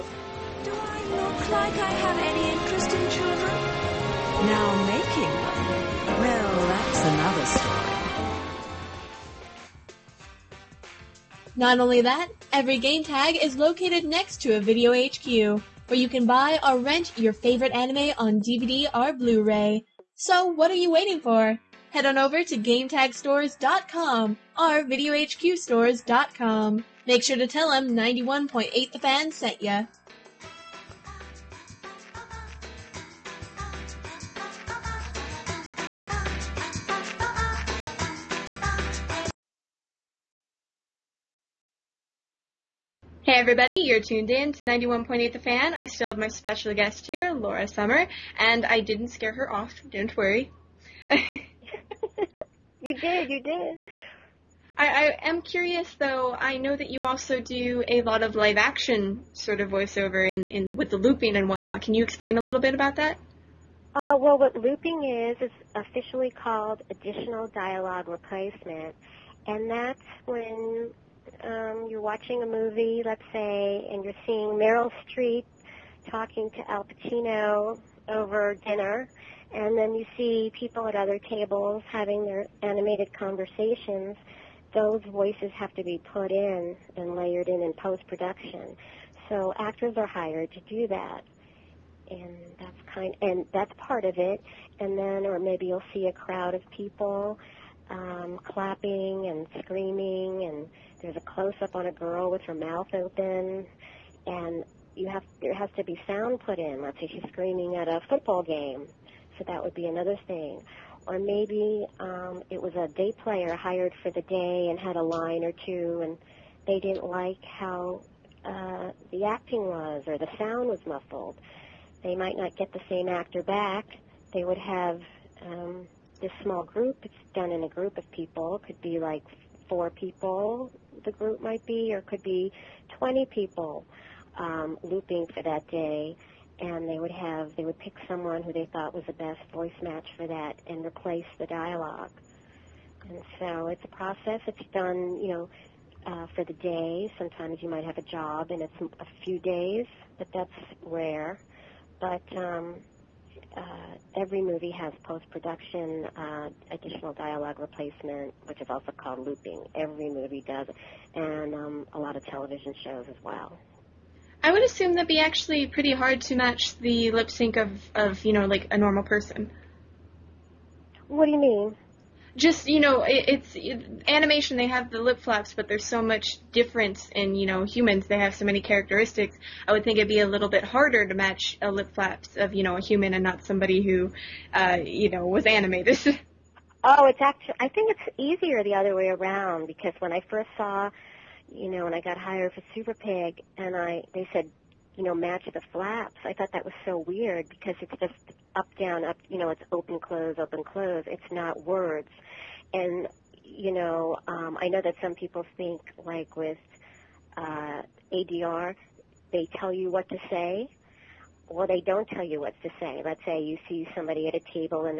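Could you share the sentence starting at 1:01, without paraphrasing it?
Can you explain a little bit about that?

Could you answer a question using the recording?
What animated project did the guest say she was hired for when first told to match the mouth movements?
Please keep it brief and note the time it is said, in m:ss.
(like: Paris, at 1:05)
Super Pig, at 3:12.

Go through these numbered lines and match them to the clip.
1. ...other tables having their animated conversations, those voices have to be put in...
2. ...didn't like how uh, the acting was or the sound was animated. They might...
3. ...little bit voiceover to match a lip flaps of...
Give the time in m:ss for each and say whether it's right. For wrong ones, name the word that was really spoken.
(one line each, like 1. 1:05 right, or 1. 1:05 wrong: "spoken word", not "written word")
1. 1:20 right
2. 1:56 wrong: "muffled", not "animated"
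3. 3:00 wrong: "harder", not "voiceover".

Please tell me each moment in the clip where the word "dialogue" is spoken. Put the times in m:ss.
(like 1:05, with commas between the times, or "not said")
1:07, 2:21, 2:37.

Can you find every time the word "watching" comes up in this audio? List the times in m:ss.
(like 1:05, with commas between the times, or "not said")
1:12.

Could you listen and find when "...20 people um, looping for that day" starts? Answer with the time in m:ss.
2:12.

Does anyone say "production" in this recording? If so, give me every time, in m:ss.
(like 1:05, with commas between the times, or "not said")
1:28, 2:35.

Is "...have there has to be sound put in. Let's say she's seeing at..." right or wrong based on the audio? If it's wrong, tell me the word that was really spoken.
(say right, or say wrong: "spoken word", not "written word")
wrong: "screaming", not "seeing".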